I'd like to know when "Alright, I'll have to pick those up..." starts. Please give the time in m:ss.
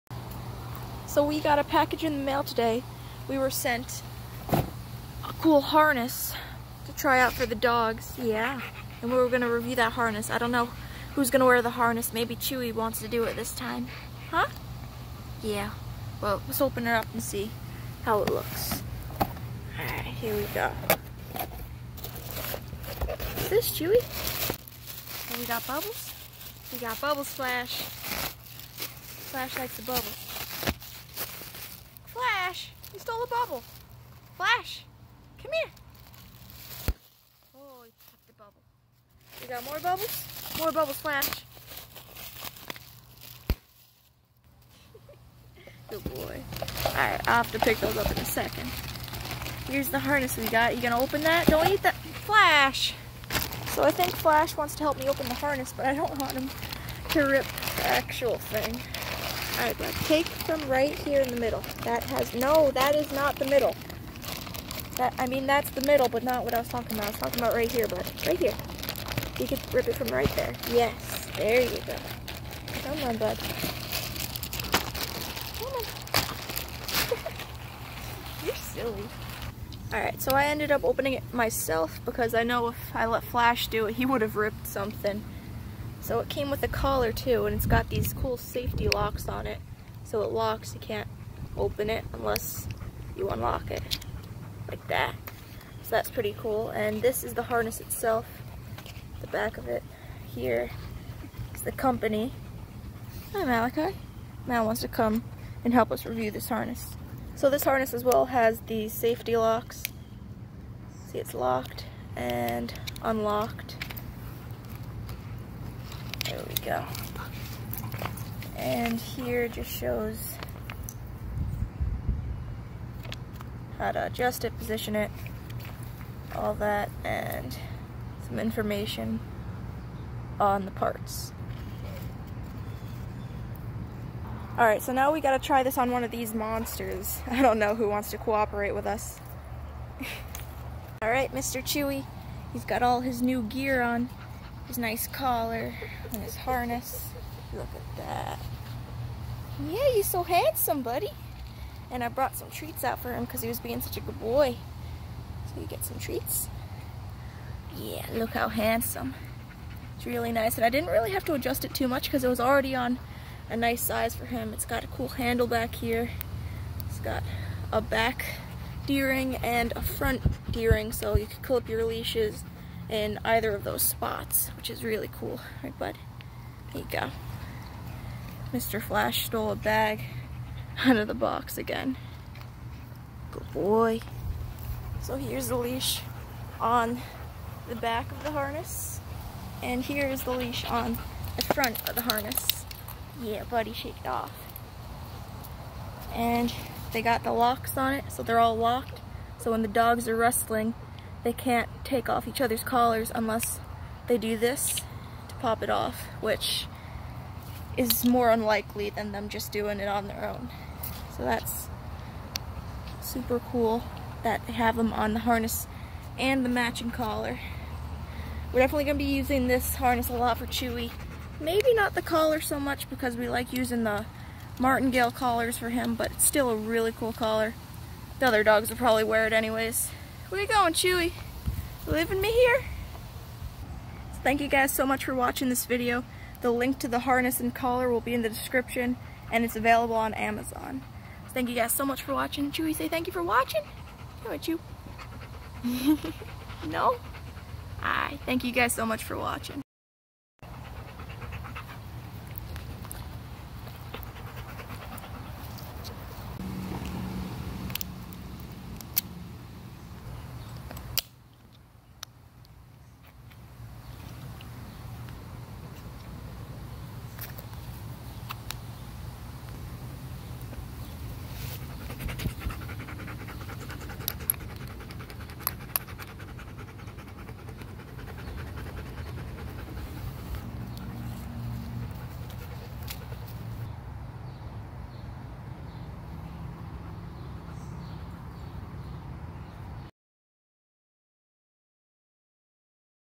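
0:46.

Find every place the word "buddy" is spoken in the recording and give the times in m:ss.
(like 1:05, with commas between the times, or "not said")
2:30, 3:13.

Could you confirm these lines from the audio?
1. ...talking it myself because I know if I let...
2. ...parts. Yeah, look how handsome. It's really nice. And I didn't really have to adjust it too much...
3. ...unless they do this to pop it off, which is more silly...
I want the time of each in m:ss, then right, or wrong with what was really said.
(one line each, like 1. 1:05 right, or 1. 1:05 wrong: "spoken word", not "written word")
1. 1:20 wrong: "opening", not "talking"
2. 2:35 wrong: "treats", not "parts"
3. 3:23 wrong: "unlikely", not "silly".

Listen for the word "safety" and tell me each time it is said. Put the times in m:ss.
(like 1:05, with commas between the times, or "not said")
1:28, 1:48.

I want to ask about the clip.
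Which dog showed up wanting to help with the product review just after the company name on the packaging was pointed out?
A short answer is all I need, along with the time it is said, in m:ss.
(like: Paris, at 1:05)
Malachi, at 1:43.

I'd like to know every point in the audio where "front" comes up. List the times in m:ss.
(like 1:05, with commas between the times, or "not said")
2:49, 3:11.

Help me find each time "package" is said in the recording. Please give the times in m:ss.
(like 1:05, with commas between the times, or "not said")
0:01.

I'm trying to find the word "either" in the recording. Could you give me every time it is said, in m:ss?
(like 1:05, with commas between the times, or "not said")
2:53.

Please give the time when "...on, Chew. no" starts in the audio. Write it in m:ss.
4:04.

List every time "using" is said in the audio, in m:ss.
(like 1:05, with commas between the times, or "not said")
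3:39, 3:43.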